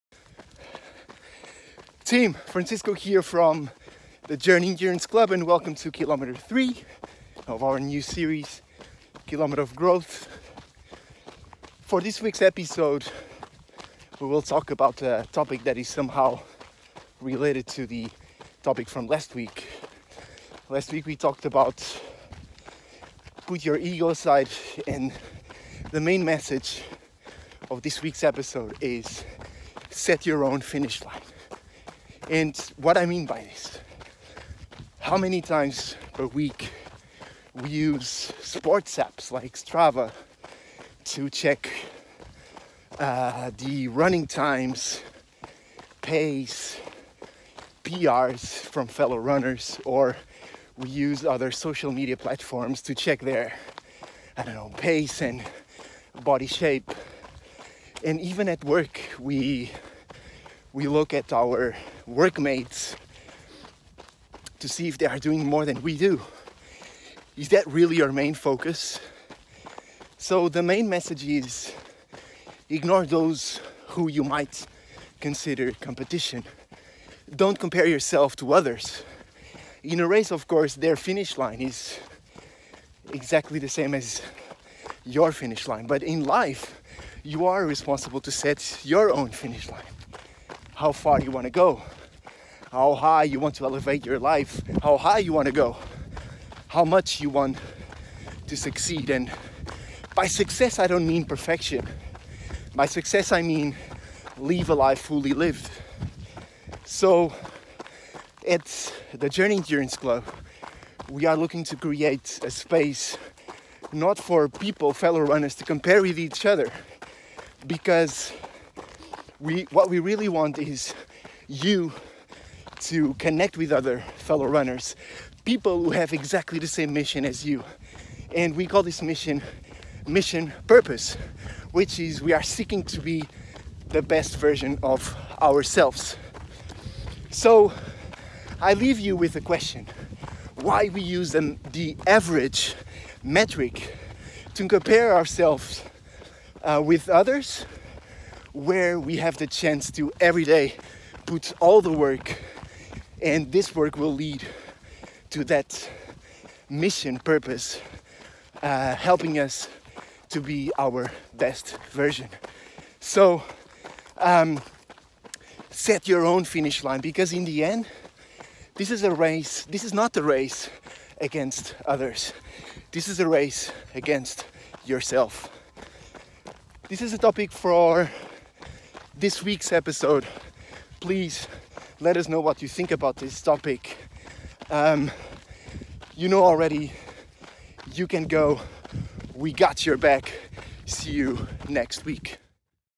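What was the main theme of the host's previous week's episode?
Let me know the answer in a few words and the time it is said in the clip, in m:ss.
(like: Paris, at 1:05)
put your ego aside, at 0:23.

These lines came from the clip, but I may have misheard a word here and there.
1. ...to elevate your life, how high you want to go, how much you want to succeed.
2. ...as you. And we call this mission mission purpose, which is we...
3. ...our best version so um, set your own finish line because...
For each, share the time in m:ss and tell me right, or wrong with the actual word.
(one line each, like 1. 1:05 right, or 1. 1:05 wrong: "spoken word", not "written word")
1. 1:33 right
2. 2:07 right
3. 2:40 right.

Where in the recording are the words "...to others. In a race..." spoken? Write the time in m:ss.
1:18.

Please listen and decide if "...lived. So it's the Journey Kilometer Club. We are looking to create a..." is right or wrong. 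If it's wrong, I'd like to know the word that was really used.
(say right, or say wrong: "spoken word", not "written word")
wrong: "Endurance", not "Kilometer".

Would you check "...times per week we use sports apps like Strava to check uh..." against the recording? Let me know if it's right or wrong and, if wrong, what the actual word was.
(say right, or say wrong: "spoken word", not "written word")
right.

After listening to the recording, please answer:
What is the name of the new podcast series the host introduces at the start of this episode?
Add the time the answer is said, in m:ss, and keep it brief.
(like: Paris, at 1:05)
Kilometer of Growth, at 0:09.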